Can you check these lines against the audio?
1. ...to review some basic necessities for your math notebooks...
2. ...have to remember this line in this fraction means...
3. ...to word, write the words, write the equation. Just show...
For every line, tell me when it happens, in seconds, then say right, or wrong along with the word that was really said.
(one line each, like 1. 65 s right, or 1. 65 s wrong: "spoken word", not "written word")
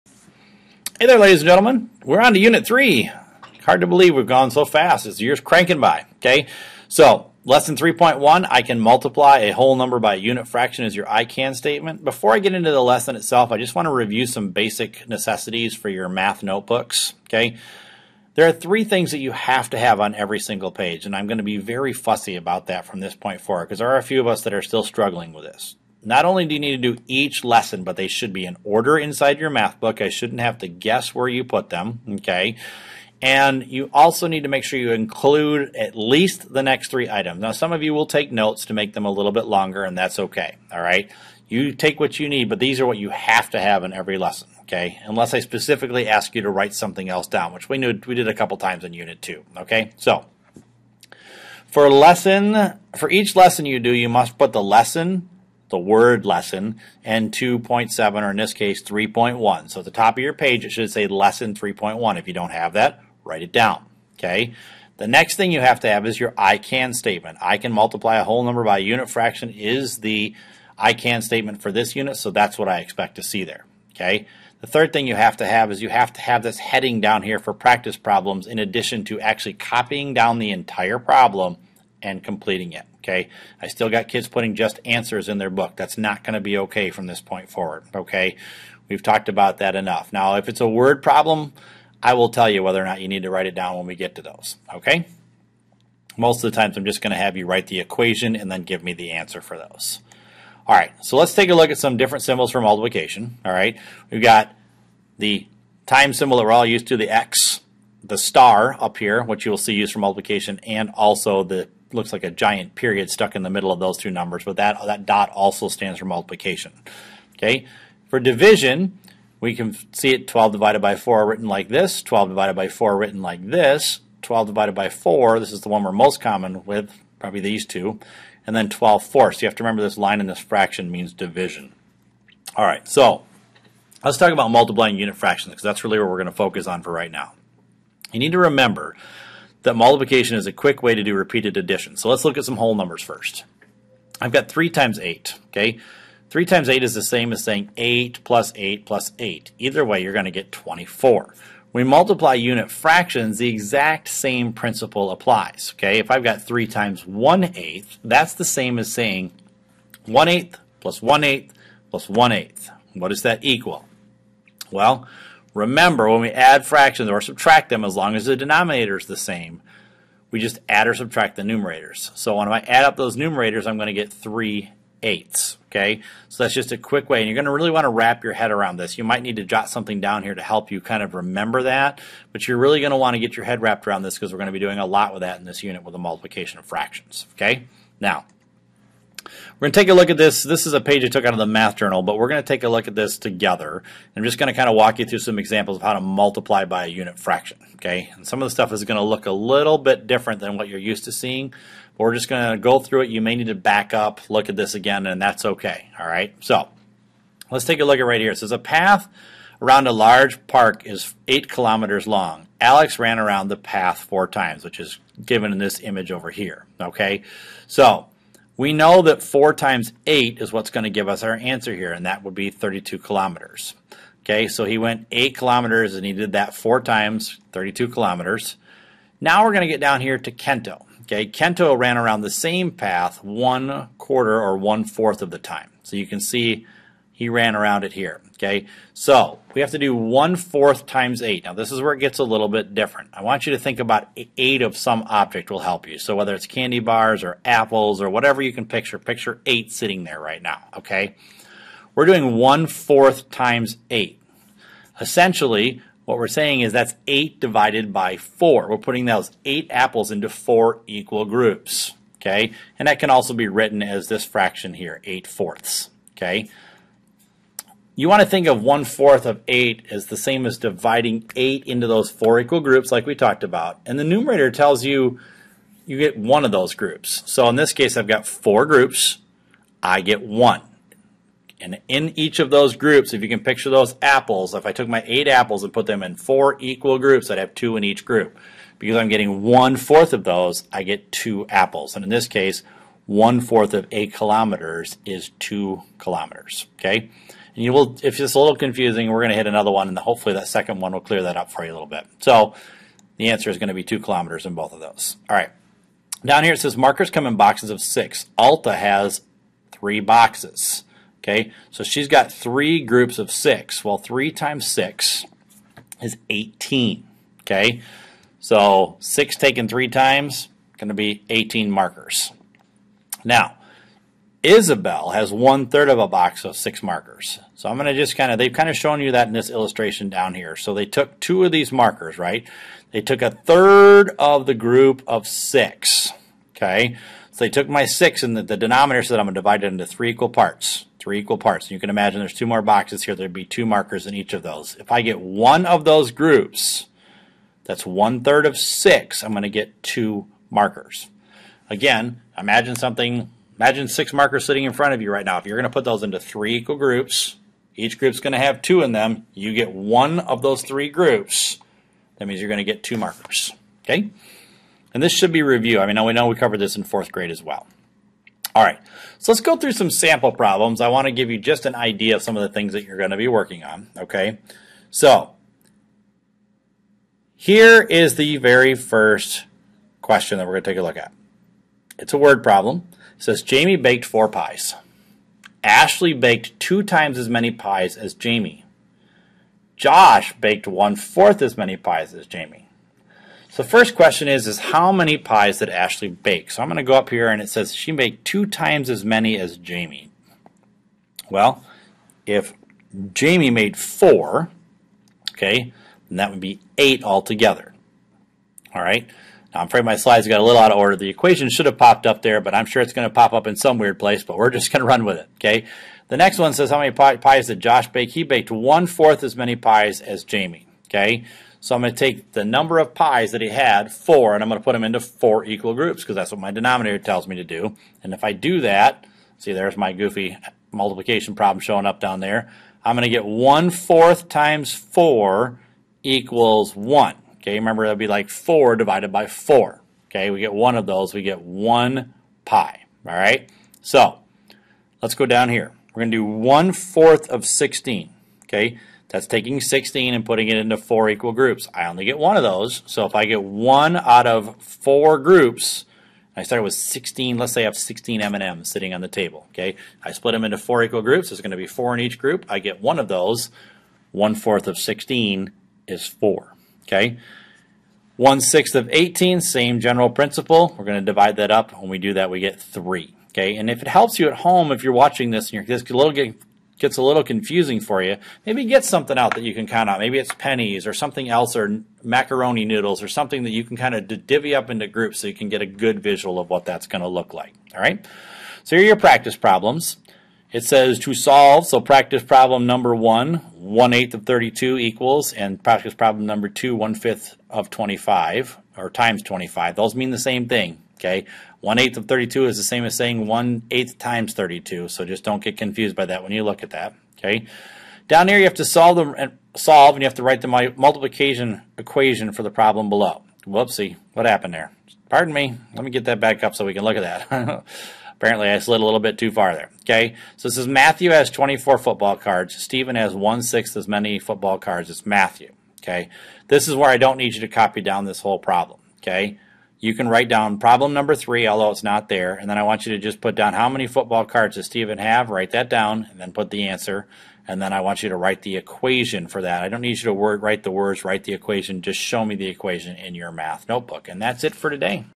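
1. 13 s right
2. 129 s right
3. 540 s right.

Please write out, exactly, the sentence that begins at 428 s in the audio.
And if I do that, see there's my goofy multiplication problem showing up down there.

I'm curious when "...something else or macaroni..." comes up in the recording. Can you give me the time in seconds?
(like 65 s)
480 s.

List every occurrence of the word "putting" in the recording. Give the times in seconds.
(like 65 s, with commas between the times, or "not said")
84 s, 258 s, 450 s.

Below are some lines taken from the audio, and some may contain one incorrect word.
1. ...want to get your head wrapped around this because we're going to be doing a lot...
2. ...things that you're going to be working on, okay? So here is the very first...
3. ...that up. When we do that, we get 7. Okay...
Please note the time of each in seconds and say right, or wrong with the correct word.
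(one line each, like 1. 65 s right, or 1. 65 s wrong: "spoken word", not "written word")
1. 182 s right
2. 372 s right
3. 471 s wrong: "3", not "7".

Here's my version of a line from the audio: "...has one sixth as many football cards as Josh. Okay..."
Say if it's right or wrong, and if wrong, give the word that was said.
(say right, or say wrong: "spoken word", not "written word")
wrong: "Matthew", not "Josh".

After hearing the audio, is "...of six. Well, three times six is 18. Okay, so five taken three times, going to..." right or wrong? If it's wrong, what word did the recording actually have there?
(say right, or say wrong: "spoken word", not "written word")
wrong: "six", not "five".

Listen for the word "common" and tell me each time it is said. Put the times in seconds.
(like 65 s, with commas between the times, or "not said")
126 s.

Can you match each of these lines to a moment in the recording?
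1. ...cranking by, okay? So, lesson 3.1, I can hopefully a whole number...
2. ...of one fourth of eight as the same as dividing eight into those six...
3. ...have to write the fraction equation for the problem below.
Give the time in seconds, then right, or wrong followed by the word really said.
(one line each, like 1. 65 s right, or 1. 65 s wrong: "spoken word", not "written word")
1. 5 s wrong: "multiply", not "hopefully"
2. 268 s wrong: "four", not "six"
3. 510 s wrong: "multiplication", not "fraction".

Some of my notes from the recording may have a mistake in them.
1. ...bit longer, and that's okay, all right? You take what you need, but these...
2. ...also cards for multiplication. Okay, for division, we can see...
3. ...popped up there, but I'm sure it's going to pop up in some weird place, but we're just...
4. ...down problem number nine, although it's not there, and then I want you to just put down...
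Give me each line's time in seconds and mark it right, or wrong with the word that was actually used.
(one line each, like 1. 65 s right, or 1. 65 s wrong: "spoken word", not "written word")
1. 39 s right
2. 115 s wrong: "stands", not "cards"
3. 411 s right
4. 530 s wrong: "three", not "nine".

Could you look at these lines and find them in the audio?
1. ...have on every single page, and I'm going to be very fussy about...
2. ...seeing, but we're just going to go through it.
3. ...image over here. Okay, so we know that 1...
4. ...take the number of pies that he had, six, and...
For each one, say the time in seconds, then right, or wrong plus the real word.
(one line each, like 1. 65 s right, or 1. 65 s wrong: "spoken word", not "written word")
1. 19 s right
2. 201 s right
3. 215 s wrong: "4", not "1"
4. 421 s wrong: "four", not "six".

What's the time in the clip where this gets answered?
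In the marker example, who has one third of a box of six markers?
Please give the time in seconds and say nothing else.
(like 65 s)
324 s.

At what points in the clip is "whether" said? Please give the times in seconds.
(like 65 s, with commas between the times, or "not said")
92 s, 246 s.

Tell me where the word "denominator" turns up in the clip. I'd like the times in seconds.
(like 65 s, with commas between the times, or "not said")
168 s, 338 s, 426 s.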